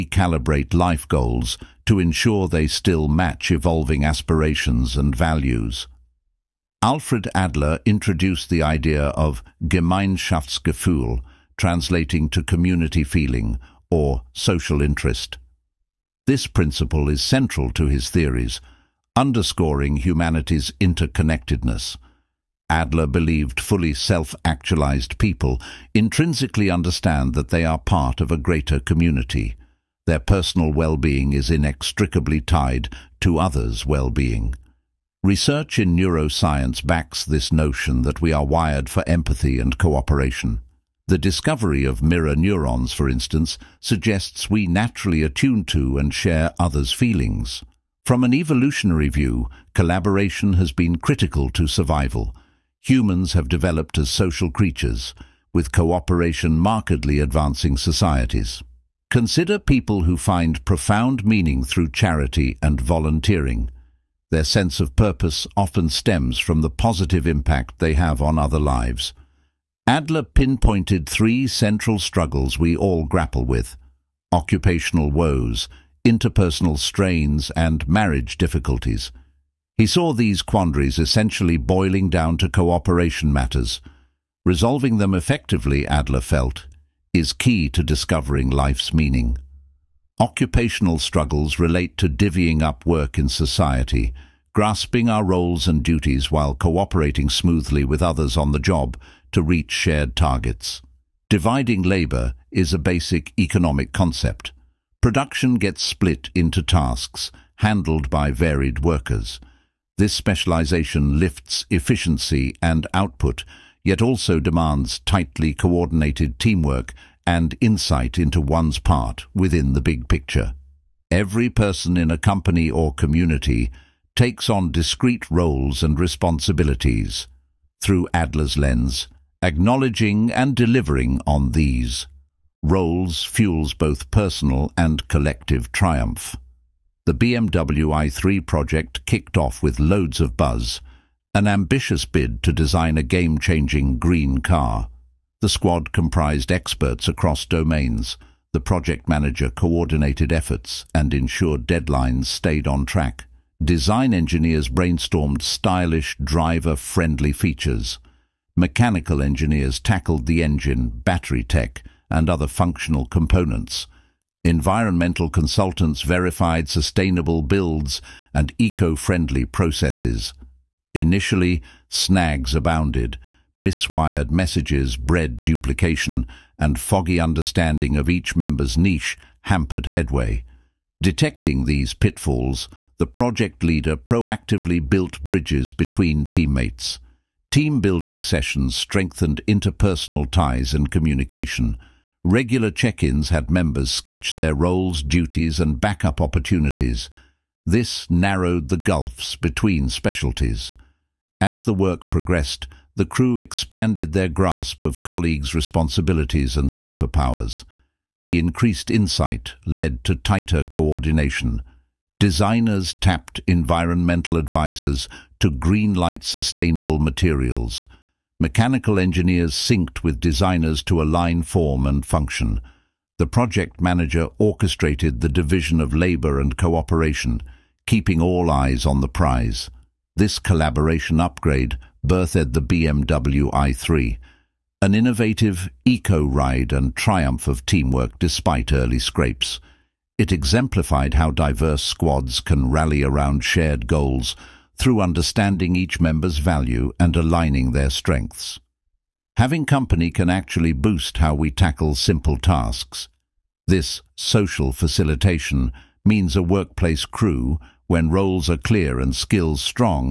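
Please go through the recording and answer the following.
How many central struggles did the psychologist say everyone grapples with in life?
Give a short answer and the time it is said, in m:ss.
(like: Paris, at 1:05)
3, at 1:11.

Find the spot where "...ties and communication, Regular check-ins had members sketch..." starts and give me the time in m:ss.
3:10.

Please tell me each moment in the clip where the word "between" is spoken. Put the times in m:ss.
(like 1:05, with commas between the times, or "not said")
3:05, 3:19.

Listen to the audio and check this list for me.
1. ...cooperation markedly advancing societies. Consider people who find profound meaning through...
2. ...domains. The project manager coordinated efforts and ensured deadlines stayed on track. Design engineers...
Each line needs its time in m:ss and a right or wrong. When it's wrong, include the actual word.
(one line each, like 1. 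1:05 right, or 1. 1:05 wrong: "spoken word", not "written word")
1. 0:55 right
2. 2:27 right.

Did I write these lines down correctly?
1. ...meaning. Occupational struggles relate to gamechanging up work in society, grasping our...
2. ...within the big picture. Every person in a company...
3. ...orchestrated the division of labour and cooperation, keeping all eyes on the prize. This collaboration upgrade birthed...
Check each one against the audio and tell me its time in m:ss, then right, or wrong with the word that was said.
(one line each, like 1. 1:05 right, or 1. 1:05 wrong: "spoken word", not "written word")
1. 1:28 wrong: "divvying", not "gamechanging"
2. 1:59 right
3. 3:44 right.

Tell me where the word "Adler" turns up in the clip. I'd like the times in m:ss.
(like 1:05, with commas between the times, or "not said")
0:07, 0:22, 1:09, 1:25, 2:08.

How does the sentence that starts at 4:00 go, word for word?
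It exemplified how diverse squads can rally around shared goals through understanding each member's value and aligning their strengths.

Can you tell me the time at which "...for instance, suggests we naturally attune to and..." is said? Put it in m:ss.
0:42.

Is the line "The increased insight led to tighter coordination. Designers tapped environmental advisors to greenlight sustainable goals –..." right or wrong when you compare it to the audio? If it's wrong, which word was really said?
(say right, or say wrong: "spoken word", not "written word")
wrong: "materials", not "goals".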